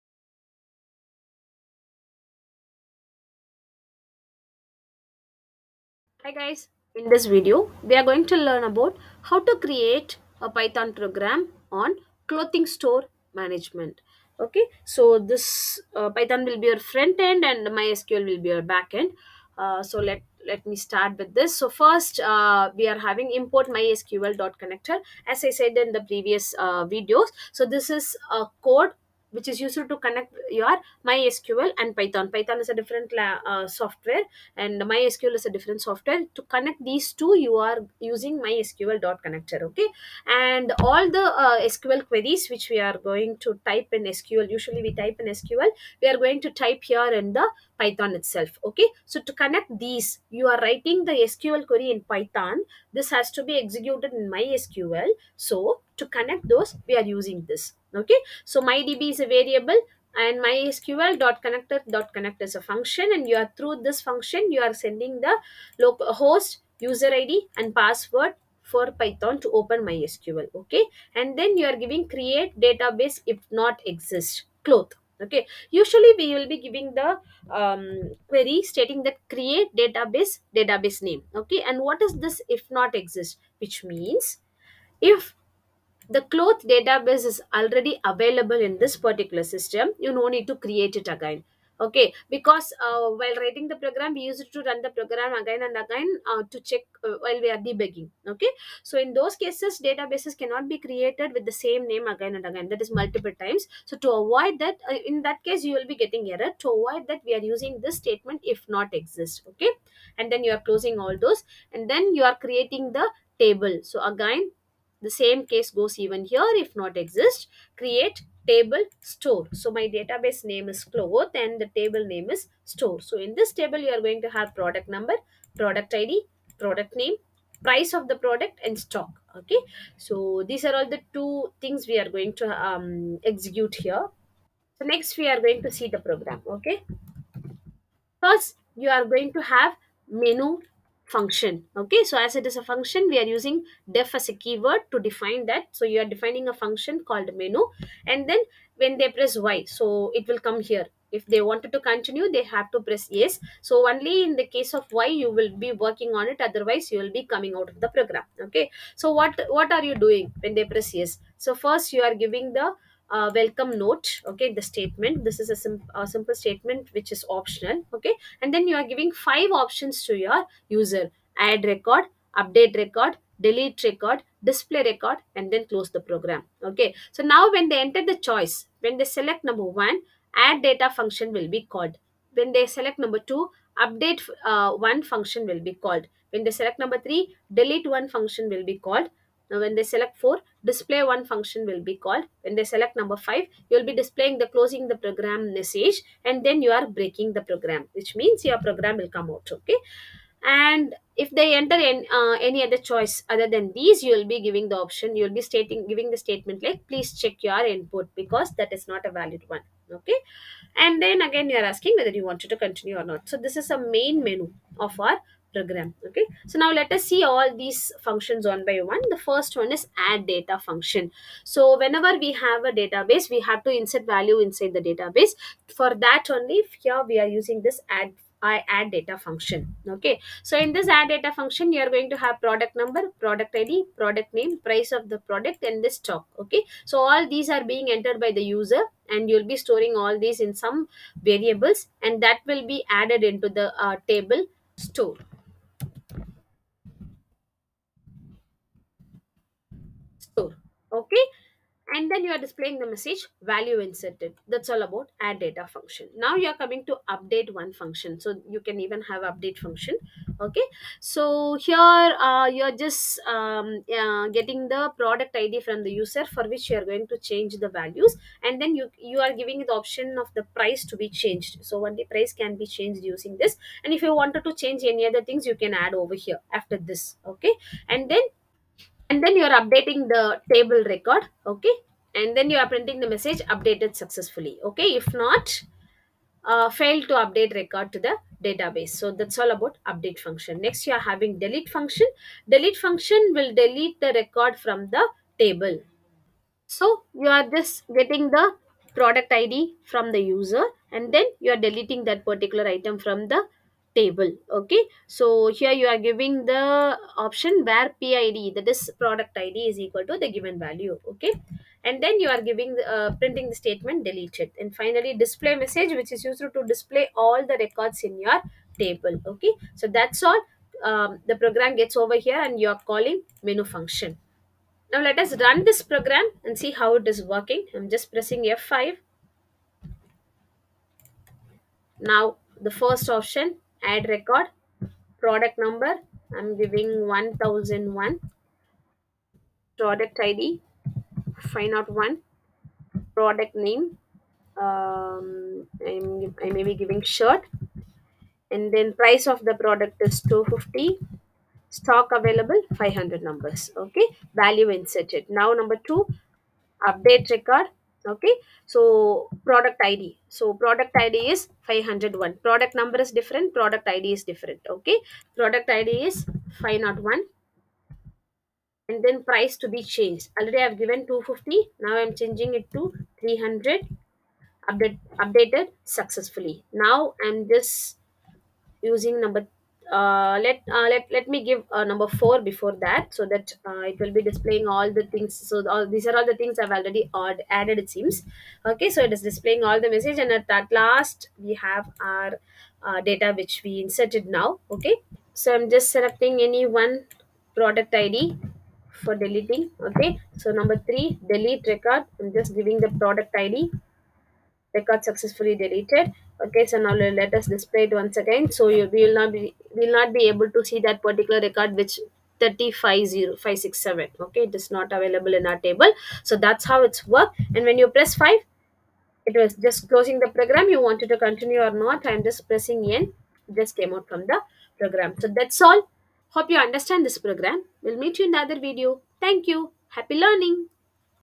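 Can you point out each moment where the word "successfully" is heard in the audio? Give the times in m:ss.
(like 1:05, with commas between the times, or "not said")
4:44, 6:15, 6:45.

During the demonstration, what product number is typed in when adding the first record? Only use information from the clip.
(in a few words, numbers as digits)
1001.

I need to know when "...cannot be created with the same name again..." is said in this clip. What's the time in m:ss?
1:40.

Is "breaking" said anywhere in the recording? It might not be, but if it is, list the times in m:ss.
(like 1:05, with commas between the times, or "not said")
3:16.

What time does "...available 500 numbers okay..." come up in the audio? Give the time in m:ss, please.
5:52.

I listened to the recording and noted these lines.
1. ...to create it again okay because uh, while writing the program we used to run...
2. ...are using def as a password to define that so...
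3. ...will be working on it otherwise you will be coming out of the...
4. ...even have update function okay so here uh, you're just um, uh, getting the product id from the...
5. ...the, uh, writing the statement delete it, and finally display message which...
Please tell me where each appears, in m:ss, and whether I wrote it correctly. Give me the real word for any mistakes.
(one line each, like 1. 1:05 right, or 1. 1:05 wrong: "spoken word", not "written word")
1. 1:30 right
2. 2:23 wrong: "keyword", not "password"
3. 2:35 right
4. 4:18 right
5. 5:12 wrong: "printing", not "writing".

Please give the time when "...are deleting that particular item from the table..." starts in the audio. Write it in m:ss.
5:01.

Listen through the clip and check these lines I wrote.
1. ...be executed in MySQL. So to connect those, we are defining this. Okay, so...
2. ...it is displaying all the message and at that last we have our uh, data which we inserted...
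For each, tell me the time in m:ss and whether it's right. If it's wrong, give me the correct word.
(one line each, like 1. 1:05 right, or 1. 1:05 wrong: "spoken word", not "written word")
1. 0:53 wrong: "using", not "defining"
2. 6:29 right.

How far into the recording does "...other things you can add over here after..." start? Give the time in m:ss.
4:35.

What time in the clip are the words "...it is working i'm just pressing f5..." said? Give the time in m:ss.
5:26.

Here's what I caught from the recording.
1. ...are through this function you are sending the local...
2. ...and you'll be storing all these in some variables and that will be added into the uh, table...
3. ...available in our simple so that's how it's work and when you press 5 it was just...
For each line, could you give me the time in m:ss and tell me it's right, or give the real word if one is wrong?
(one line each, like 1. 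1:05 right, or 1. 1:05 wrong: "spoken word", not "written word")
1. 1:03 right
2. 3:59 right
3. 6:54 wrong: "table", not "simple".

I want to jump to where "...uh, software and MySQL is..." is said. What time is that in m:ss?
0:33.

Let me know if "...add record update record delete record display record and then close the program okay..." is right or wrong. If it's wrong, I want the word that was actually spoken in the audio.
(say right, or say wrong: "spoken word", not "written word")
right.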